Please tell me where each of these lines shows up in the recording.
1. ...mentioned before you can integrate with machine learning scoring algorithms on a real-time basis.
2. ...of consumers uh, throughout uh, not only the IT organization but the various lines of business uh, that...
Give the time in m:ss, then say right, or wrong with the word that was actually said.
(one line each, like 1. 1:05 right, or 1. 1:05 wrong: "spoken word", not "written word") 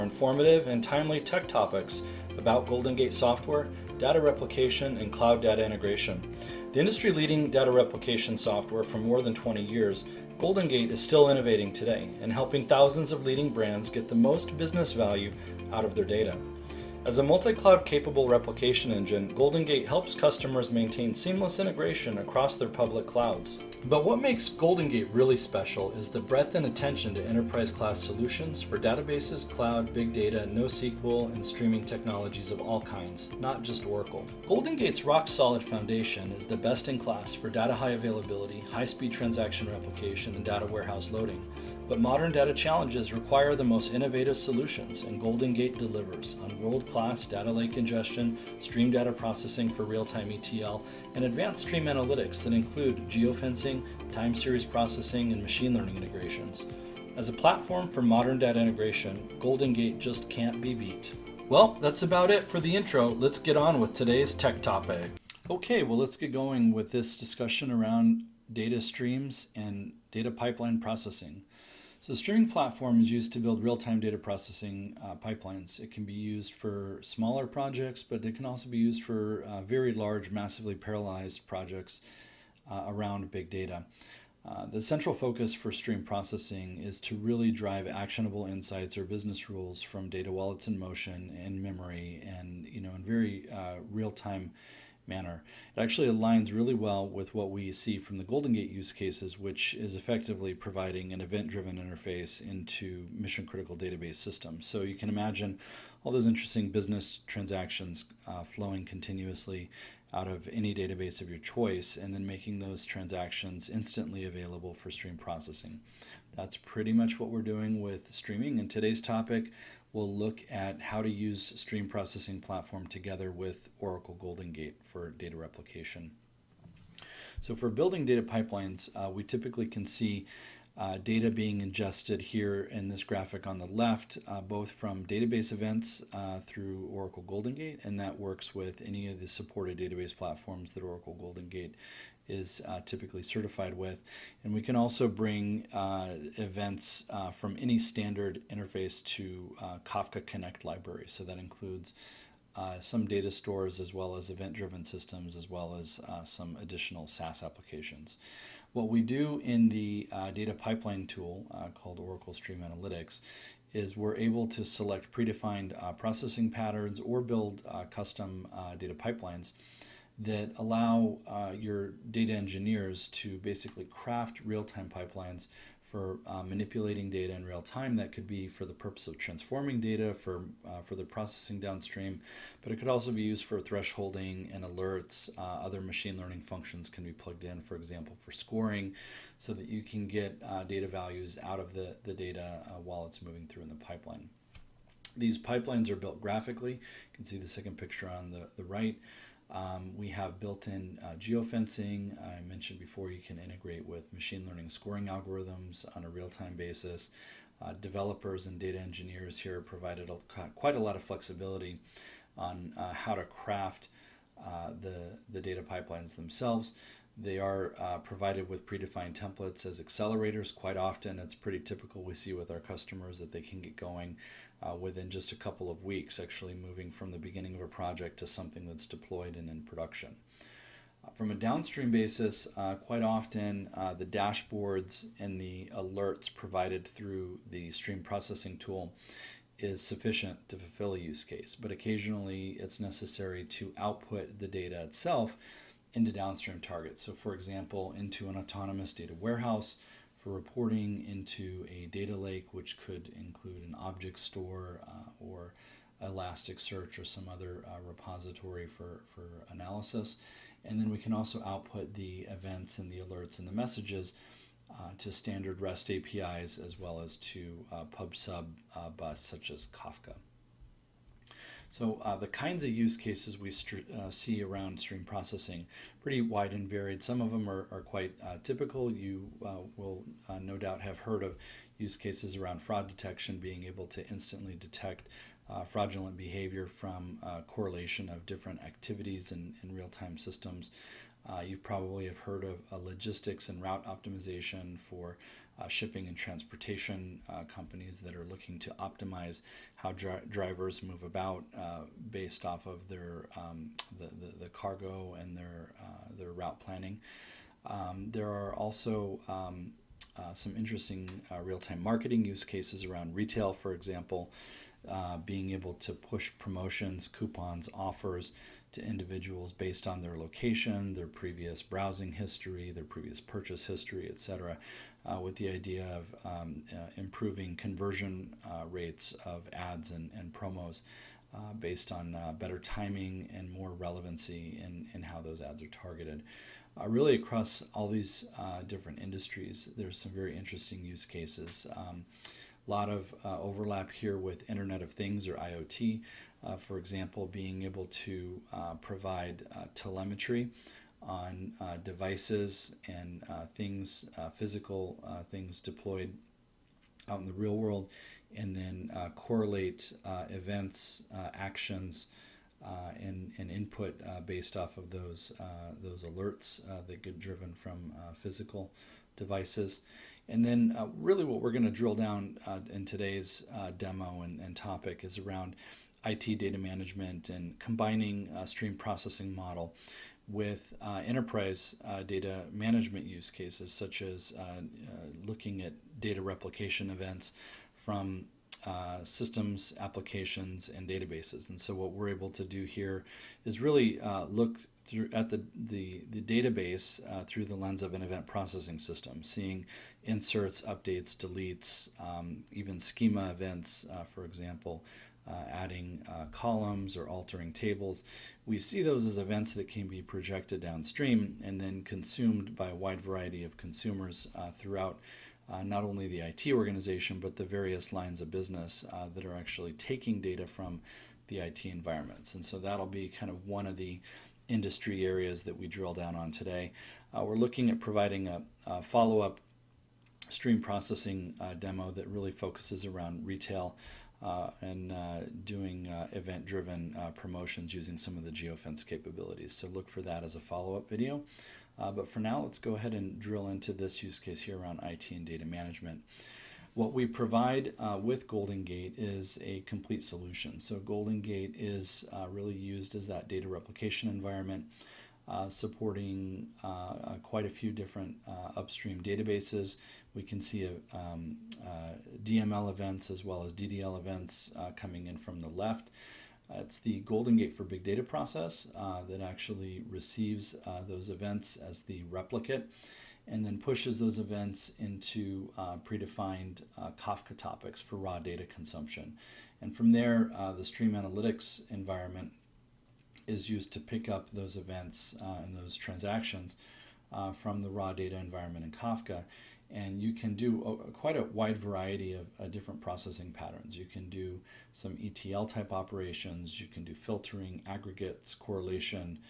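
1. 3:22 right
2. 6:53 right.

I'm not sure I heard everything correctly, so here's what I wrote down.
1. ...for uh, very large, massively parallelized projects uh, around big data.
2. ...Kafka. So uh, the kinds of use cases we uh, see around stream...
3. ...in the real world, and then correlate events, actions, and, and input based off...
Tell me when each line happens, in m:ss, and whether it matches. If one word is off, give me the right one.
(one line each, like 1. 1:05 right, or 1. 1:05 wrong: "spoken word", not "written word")
1. 1:19 right
2. 4:29 right
3. 5:57 right.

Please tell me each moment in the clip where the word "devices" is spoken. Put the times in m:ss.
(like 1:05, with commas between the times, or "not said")
5:51, 6:09.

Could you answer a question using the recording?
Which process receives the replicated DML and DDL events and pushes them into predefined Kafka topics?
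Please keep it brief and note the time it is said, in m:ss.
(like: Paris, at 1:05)
Golden Gate for Big Data, at 7:47.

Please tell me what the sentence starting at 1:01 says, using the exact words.
Well, that's about it for the intro.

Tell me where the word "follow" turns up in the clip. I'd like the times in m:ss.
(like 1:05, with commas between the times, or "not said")
7:08, 7:20.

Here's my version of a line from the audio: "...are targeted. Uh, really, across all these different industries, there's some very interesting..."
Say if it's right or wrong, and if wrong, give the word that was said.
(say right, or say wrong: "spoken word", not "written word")
right.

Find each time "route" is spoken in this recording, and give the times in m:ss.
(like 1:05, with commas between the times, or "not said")
4:53, 5:06.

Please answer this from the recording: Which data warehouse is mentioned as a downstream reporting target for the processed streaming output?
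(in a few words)
Autonomous data warehouse.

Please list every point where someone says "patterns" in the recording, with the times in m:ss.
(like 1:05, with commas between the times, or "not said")
2:46, 8:13.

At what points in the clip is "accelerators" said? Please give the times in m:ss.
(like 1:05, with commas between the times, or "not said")
3:39.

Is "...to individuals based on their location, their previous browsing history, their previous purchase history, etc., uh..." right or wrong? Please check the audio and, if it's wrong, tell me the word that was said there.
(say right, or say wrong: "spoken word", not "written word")
right.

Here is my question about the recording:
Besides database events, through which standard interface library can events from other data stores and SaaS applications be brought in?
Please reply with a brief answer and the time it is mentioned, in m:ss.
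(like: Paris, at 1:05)
Kafka Connect, at 2:29.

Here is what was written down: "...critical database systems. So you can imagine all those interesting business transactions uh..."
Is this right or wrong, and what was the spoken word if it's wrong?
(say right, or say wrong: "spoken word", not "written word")
right.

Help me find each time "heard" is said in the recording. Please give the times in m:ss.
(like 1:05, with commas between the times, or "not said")
4:40, 4:52.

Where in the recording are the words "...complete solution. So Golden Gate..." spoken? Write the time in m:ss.
7:29.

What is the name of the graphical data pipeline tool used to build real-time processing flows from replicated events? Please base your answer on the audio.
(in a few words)
Oracle Stream Analytics.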